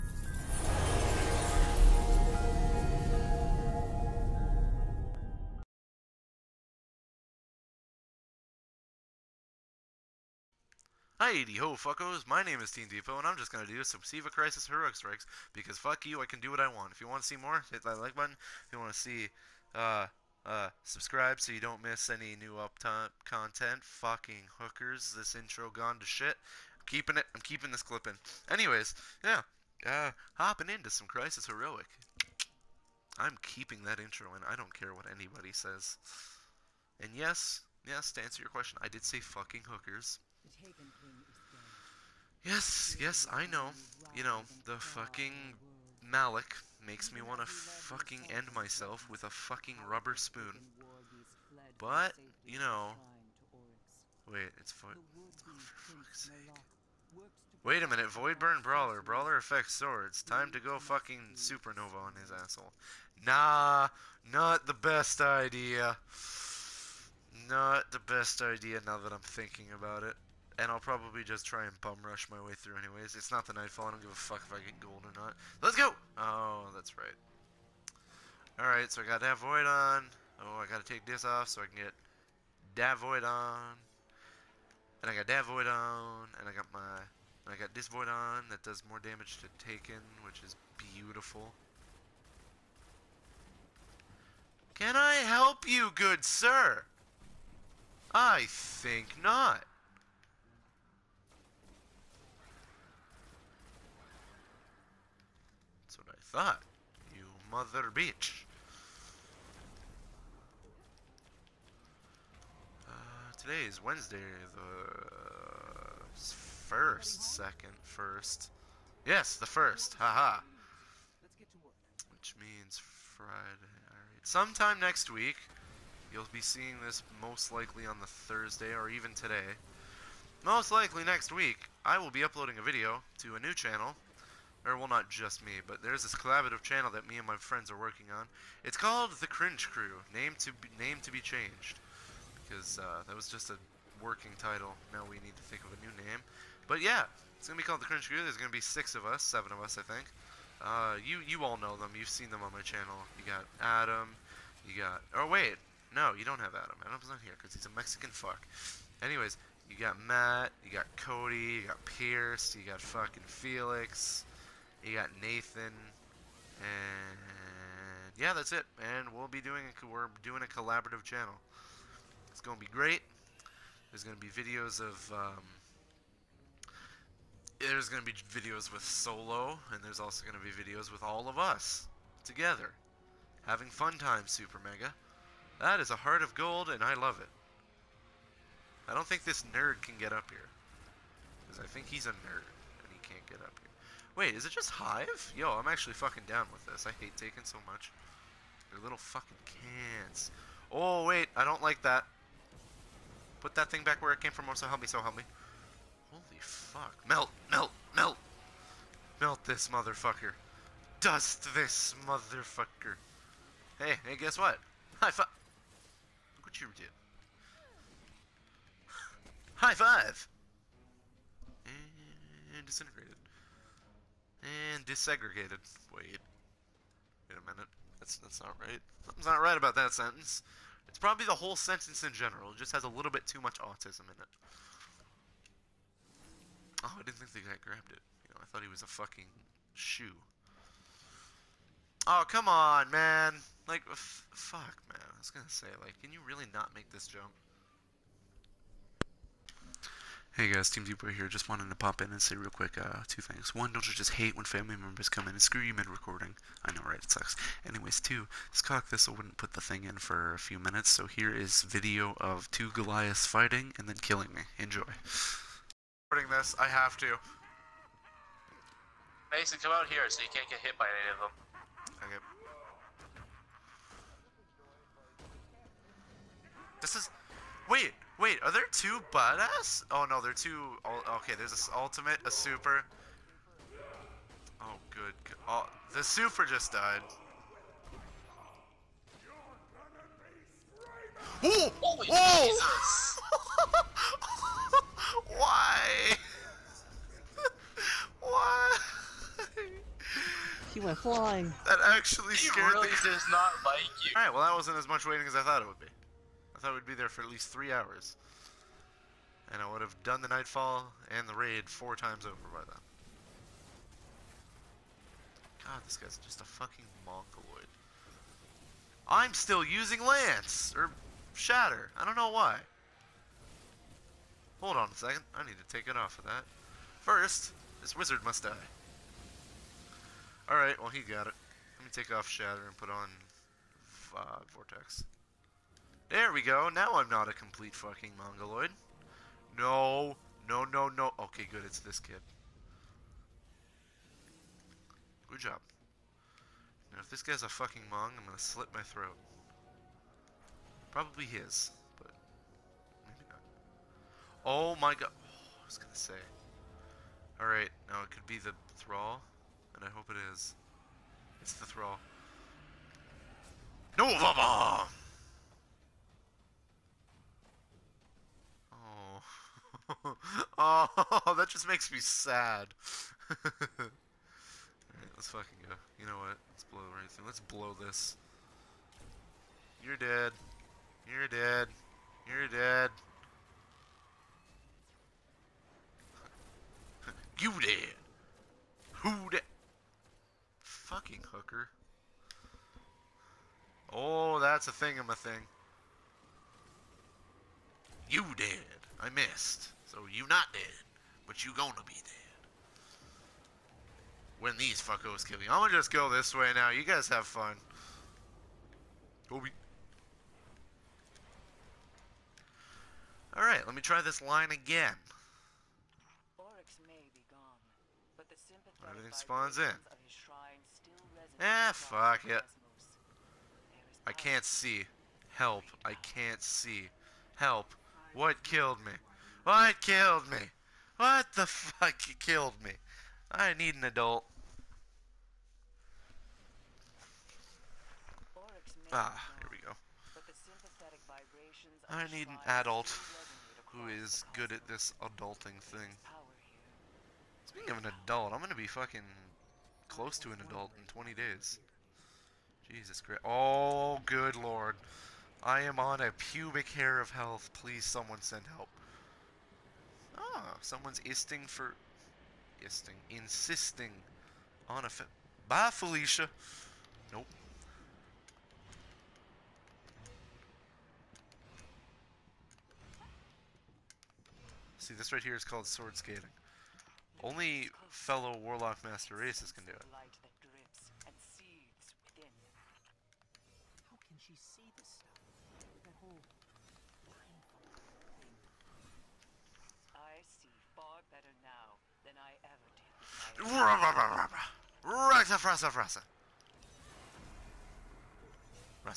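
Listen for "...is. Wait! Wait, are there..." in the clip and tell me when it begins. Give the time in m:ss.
4:36.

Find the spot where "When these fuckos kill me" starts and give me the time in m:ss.
6:44.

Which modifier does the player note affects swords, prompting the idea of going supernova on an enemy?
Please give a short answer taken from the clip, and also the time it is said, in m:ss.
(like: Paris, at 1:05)
Voidburn Brawler, at 0:58.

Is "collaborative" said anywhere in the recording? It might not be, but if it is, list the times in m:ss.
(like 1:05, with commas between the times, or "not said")
2:16, 2:50.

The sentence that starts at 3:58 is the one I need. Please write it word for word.
You know, I thought he was a fucking shoe.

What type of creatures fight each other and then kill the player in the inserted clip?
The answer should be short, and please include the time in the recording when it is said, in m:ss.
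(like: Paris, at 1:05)
Goliaths, at 4:22.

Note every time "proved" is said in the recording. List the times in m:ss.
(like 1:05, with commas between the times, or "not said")
not said.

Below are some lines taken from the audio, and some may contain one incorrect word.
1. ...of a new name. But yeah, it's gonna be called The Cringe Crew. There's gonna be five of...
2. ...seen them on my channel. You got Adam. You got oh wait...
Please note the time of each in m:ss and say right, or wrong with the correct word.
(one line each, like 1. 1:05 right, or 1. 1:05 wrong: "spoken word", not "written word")
1. 2:25 wrong: "six", not "five"
2. 2:32 right.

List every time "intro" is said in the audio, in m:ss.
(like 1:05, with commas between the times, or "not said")
0:25, 0:33.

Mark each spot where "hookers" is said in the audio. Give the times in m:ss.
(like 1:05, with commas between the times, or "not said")
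0:24, 0:39, 6:31.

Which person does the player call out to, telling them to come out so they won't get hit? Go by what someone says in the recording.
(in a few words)
Mason.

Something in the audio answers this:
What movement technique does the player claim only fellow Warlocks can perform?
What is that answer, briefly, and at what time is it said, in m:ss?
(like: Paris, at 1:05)
Sword skating, at 7:55.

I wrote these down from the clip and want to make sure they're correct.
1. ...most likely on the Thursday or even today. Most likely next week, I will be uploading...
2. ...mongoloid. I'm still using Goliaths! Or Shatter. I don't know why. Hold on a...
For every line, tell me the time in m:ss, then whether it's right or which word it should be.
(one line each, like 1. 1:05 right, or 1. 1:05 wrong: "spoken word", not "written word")
1. 2:07 right
2. 5:17 wrong: "Lance", not "Goliaths".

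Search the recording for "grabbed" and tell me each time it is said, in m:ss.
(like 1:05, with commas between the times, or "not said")
3:57.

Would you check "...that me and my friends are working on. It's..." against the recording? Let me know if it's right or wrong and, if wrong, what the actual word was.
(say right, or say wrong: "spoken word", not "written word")
right.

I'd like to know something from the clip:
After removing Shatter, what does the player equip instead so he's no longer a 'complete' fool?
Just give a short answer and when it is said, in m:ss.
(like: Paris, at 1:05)
Vortex, at 5:34.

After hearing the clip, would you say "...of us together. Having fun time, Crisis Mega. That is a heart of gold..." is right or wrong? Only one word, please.
wrong.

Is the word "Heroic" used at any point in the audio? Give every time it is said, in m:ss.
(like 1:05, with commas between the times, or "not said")
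0:14, 0:31.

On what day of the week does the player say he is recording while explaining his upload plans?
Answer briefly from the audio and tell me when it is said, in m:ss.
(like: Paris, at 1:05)
Wednesday, at 1:53.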